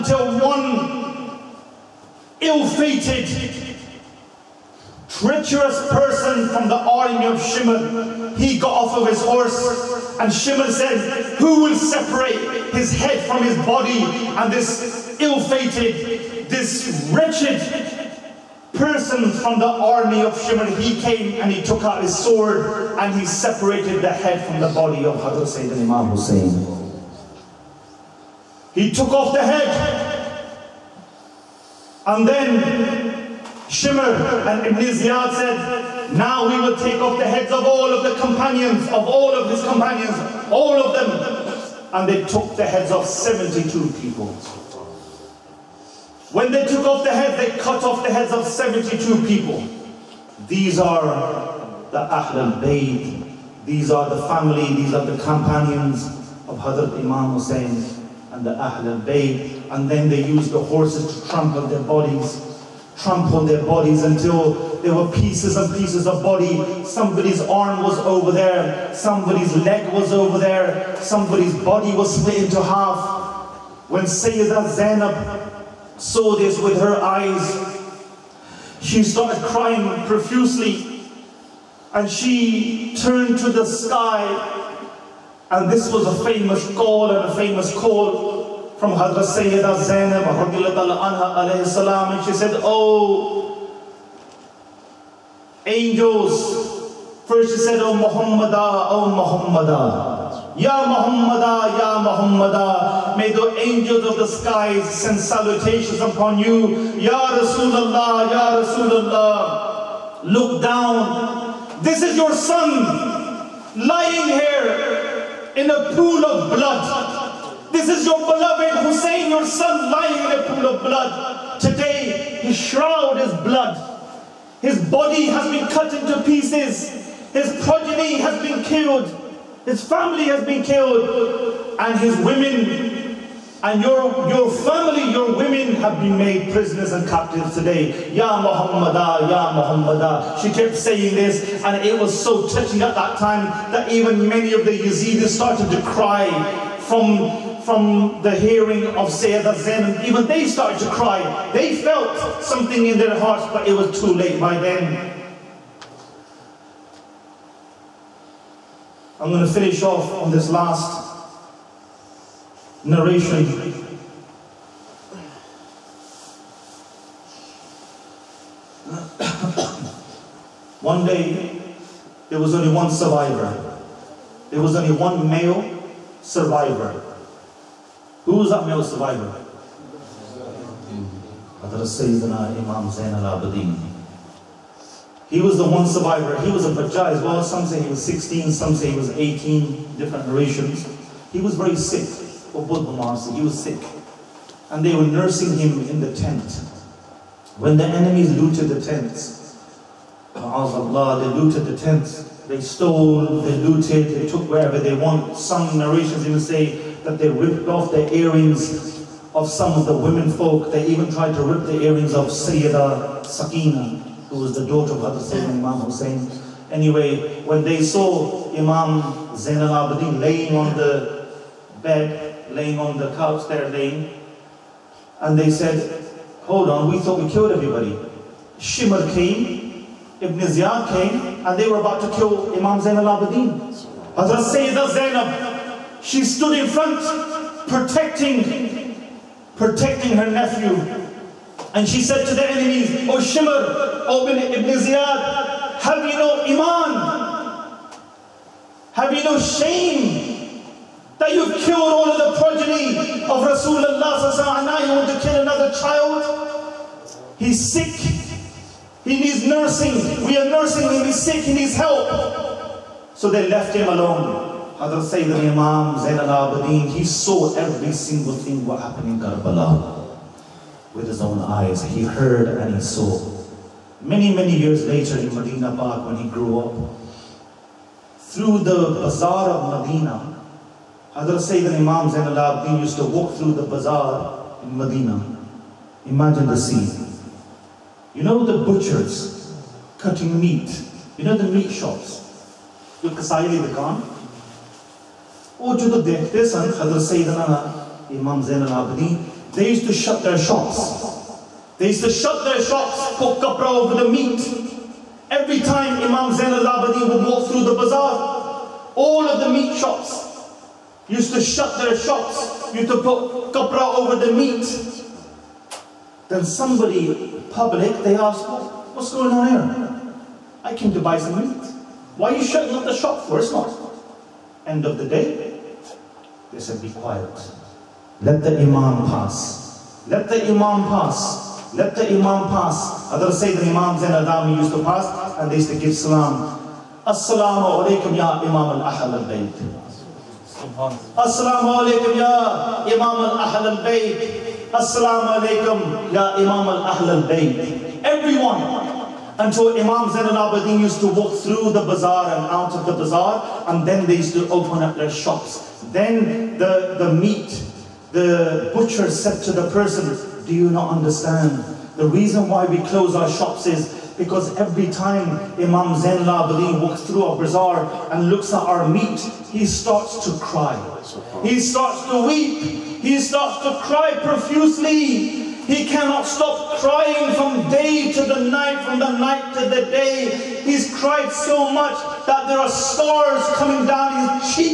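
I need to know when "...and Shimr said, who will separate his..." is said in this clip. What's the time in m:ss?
0:10.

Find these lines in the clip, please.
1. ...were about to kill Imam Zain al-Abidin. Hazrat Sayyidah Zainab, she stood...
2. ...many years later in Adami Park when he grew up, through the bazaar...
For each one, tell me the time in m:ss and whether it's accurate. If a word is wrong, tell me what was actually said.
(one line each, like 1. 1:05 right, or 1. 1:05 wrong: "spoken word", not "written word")
1. 3:51 right
2. 4:34 wrong: "Medina", not "Adami".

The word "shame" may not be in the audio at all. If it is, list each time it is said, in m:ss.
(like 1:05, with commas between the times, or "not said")
4:09.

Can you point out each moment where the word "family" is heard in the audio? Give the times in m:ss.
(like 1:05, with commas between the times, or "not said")
0:54, 2:09, 2:14.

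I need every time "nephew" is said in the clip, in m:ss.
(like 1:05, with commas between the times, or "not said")
4:00.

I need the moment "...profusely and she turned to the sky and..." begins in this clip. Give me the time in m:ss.
1:20.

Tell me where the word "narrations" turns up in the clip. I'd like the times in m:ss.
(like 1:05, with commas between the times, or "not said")
2:42, 3:10, 3:25.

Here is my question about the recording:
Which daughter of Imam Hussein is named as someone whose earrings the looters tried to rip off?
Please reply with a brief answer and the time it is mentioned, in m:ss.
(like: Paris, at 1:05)
Sayyidah Sakina, at 3:32.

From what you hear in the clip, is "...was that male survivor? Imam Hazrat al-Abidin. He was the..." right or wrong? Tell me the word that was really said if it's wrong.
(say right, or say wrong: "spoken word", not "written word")
wrong: "Zain", not "Hazrat".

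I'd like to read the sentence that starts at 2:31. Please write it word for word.
They felt something in their hearts, but it was too late by then.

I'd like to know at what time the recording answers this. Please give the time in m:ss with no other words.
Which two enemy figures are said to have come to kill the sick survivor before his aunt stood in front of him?
3:48.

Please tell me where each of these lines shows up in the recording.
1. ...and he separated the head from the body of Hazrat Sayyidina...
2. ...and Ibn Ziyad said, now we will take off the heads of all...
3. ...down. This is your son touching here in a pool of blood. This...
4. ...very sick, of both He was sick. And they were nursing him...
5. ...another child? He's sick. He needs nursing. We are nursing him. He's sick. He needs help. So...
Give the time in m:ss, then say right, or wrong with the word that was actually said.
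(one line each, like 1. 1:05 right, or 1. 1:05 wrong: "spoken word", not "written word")
1. 0:22 right
2. 0:34 right
3. 1:50 wrong: "lying", not "touching"
4. 3:11 right
5. 4:15 right.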